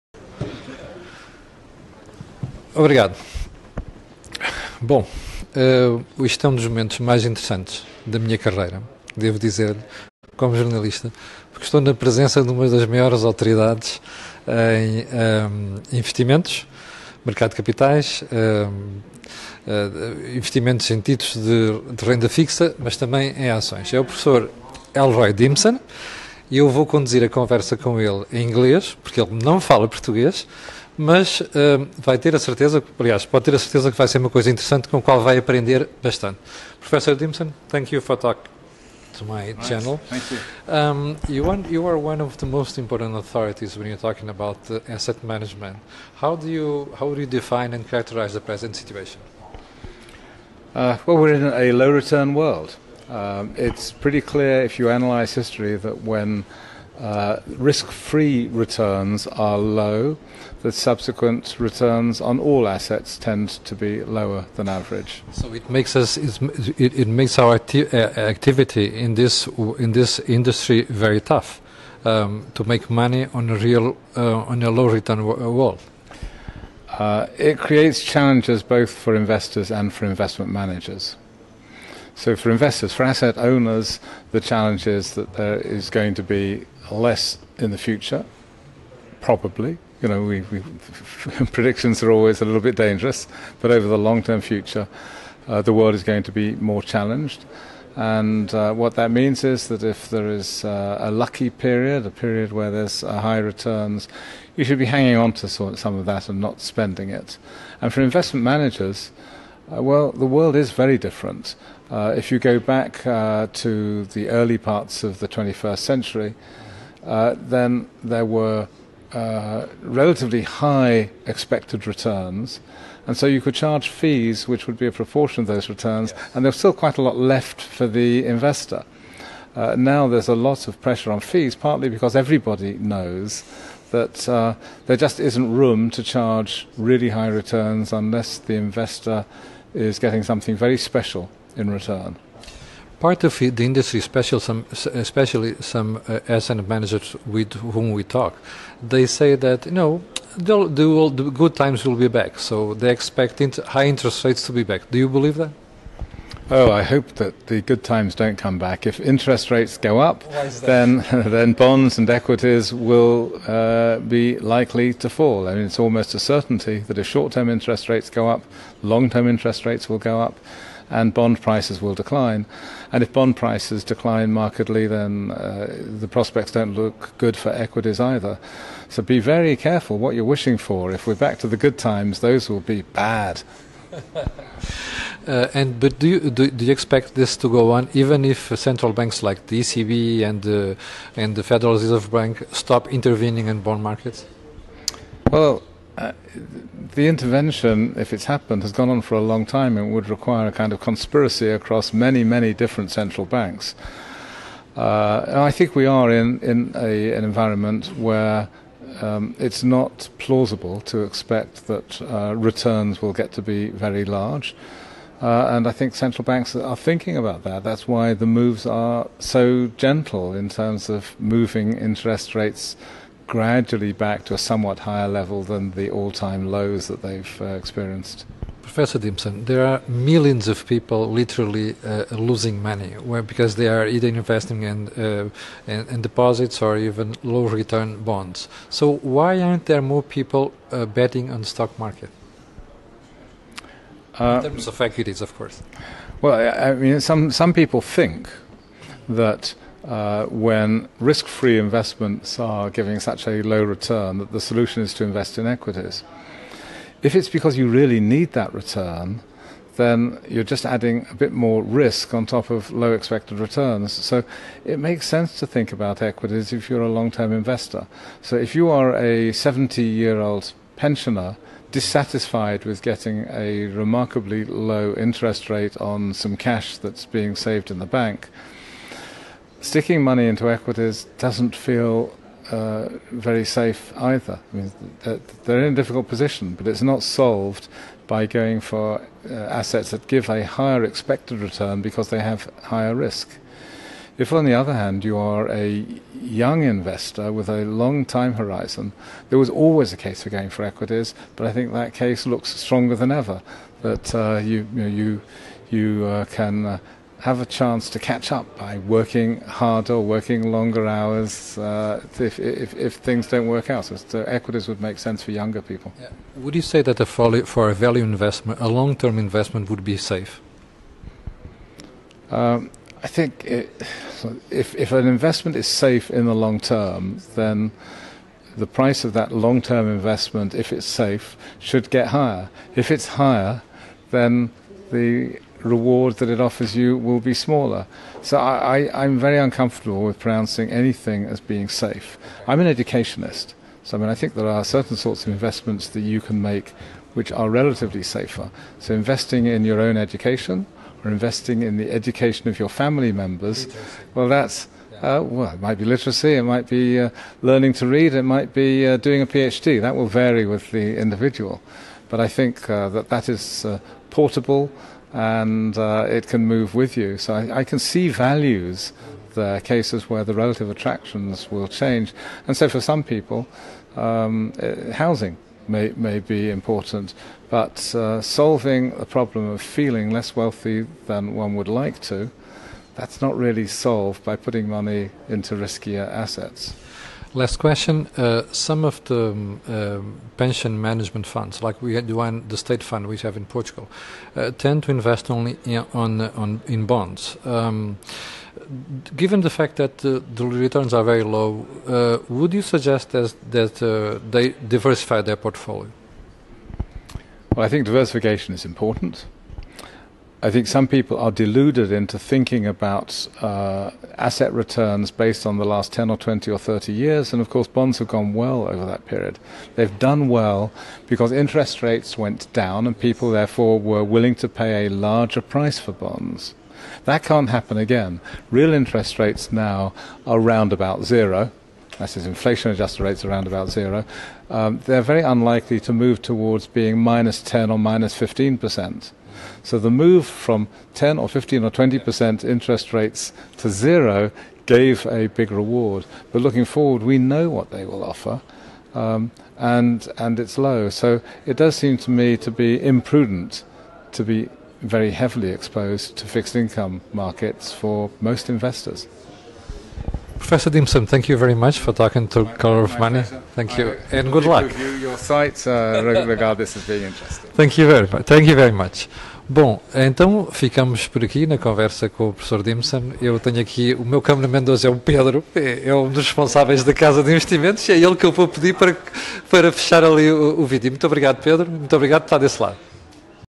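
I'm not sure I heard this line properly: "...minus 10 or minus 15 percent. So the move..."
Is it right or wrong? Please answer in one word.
right.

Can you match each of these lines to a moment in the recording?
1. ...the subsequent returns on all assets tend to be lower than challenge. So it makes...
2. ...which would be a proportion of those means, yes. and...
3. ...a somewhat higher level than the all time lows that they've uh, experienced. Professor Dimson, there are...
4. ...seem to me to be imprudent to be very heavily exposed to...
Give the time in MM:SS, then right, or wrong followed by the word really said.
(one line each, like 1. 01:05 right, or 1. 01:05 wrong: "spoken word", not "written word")
1. 01:00 wrong: "average", not "challenge"
2. 02:04 wrong: "returns", not "means"
3. 03:44 right
4. 07:31 right.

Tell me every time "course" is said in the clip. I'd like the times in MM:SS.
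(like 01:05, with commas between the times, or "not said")
04:05, 06:57.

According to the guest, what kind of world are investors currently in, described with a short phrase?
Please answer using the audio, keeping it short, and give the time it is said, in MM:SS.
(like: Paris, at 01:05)
low return world, at 00:51.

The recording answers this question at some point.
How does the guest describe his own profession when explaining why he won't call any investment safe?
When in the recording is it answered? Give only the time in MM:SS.
05:42.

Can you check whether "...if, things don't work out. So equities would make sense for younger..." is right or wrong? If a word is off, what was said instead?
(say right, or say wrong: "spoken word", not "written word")
right.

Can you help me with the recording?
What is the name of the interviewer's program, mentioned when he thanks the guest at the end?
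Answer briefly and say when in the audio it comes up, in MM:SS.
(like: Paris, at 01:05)
Color of Money, at 07:42.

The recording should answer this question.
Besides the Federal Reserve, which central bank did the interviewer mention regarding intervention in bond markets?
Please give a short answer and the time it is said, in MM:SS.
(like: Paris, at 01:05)
ECB, at 03:09.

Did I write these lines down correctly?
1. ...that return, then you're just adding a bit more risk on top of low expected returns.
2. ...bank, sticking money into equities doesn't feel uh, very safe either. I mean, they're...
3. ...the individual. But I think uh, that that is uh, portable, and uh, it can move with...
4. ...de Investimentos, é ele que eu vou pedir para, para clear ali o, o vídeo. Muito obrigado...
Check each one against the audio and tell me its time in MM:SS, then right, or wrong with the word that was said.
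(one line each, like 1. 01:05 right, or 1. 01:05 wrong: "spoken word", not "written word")
1. 04:18 right
2. 04:37 right
3. 06:00 right
4. 07:57 wrong: "fechar", not "clear".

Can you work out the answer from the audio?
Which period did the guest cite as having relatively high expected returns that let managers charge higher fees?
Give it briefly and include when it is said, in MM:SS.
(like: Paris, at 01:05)
early 21st century, at 01:54.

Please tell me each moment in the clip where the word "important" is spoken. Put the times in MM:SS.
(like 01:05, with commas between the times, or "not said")
00:42, 06:16, 06:48.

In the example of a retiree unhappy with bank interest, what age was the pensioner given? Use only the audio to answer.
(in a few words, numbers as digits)
70.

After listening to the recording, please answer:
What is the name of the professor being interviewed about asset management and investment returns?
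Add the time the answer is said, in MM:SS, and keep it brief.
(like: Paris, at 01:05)
Elroy Dimson, at 00:24.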